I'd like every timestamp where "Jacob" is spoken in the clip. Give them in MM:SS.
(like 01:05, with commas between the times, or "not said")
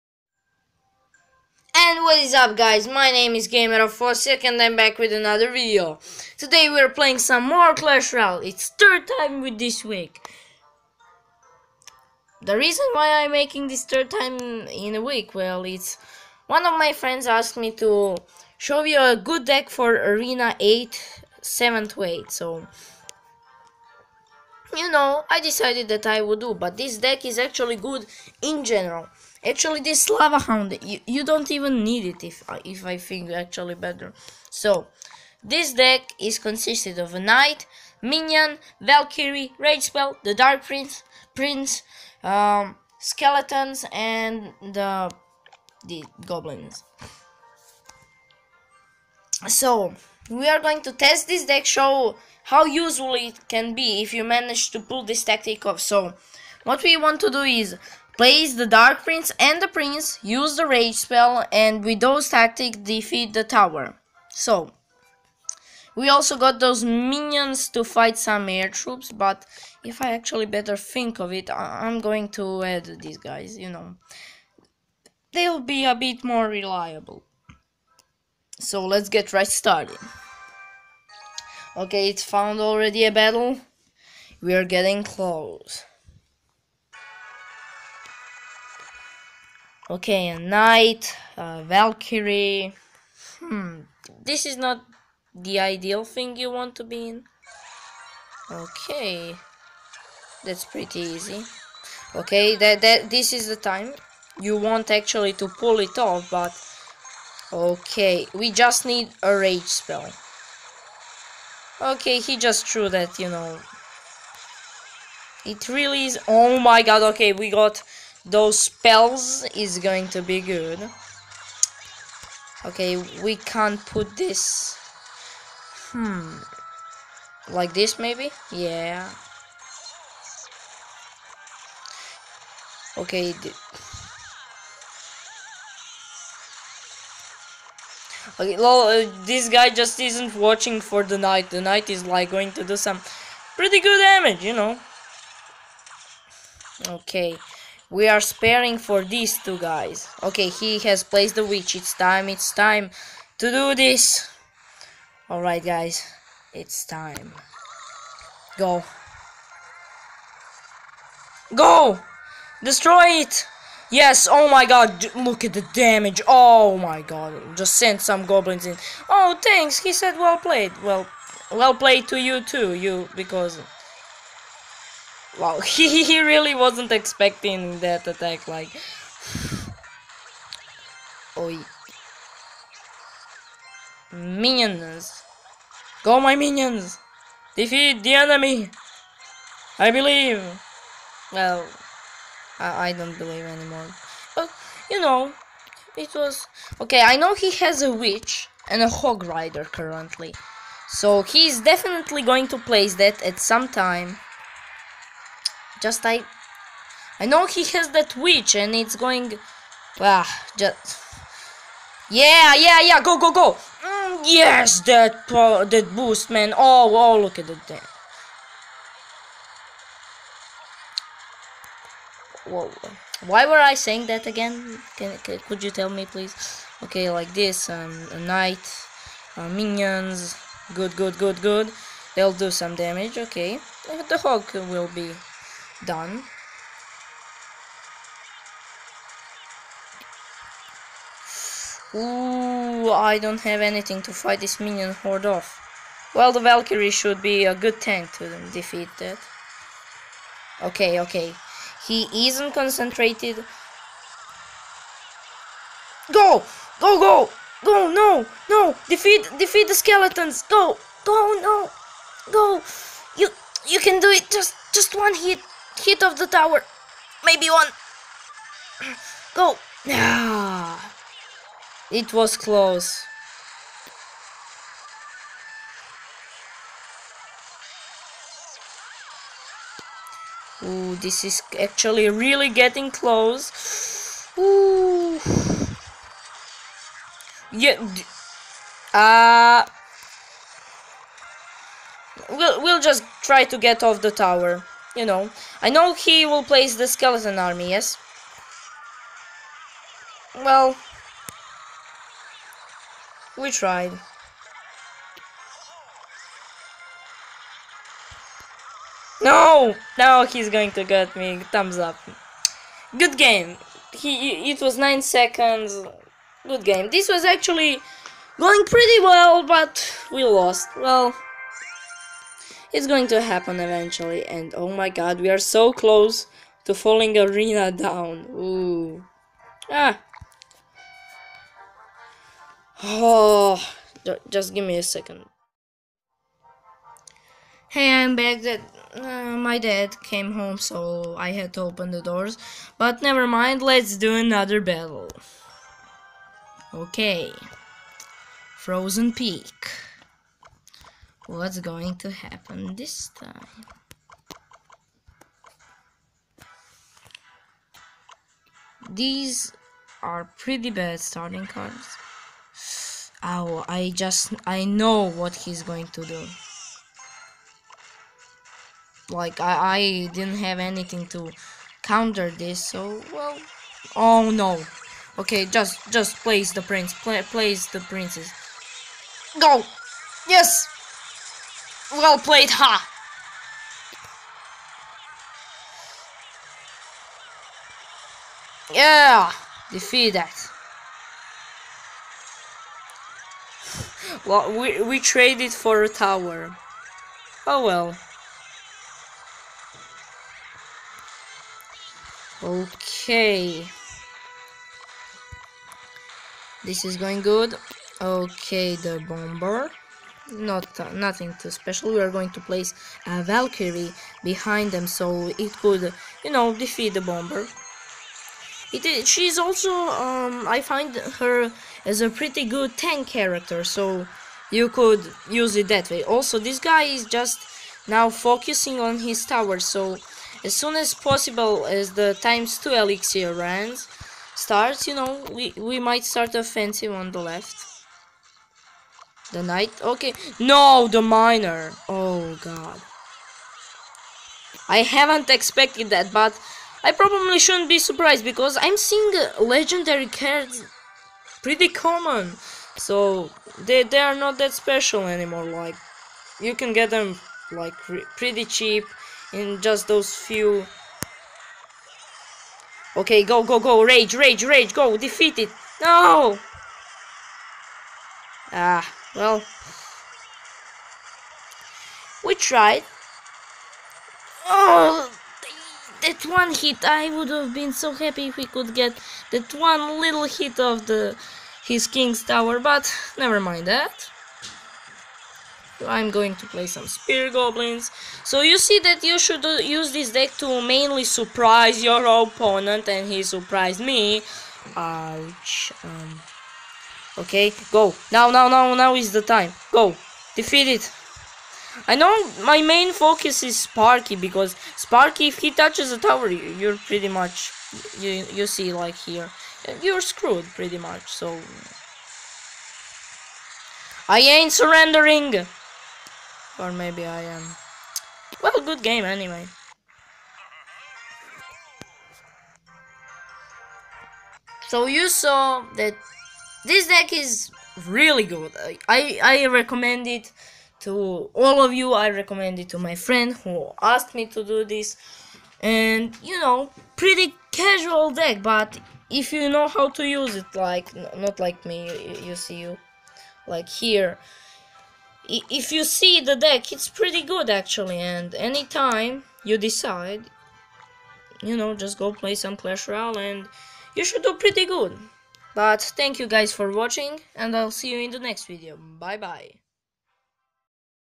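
not said.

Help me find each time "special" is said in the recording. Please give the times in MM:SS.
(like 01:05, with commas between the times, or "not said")
06:51, 07:34.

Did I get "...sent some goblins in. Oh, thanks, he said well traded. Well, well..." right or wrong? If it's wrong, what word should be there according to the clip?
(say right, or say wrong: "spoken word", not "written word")
wrong: "played", not "traded".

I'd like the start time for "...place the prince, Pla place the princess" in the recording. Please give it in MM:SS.
06:16.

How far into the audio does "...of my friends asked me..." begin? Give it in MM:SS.
00:16.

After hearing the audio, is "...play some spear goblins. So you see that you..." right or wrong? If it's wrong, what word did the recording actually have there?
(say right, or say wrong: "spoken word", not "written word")
right.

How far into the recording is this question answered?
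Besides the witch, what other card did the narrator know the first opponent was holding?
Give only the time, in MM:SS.
03:18.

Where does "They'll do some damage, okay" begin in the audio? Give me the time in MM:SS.
03:52.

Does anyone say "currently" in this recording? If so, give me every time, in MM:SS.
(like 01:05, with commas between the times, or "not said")
03:19.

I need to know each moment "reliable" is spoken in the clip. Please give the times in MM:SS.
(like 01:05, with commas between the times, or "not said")
01:16.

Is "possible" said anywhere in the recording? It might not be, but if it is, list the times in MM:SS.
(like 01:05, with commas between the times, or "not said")
07:10.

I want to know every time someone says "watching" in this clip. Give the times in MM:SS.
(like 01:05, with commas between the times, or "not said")
02:20, 09:16.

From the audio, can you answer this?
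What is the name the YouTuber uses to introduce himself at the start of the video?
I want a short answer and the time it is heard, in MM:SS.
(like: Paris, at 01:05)
Gamer46, at 00:03.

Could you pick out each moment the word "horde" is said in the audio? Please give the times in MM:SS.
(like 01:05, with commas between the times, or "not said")
04:04.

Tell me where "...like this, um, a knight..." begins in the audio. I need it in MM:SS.
03:47.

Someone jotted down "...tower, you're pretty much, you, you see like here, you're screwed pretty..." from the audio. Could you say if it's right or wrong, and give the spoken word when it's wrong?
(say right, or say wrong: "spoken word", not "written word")
right.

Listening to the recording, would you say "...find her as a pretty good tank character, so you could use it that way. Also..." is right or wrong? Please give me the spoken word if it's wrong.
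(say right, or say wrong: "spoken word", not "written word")
right.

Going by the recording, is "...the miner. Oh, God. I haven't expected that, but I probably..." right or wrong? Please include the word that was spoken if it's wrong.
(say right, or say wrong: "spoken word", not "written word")
right.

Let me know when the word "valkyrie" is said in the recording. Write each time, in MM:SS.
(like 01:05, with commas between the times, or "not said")
00:38, 01:31, 04:06, 06:53.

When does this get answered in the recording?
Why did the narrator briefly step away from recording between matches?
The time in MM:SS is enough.
05:39.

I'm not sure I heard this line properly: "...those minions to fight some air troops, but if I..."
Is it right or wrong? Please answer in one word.
right.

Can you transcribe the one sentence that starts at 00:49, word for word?
So we are going to test this deck, show how useful it can be if you manage to pull this tactic off.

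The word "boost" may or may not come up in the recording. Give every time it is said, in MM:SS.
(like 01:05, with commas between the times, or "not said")
03:35.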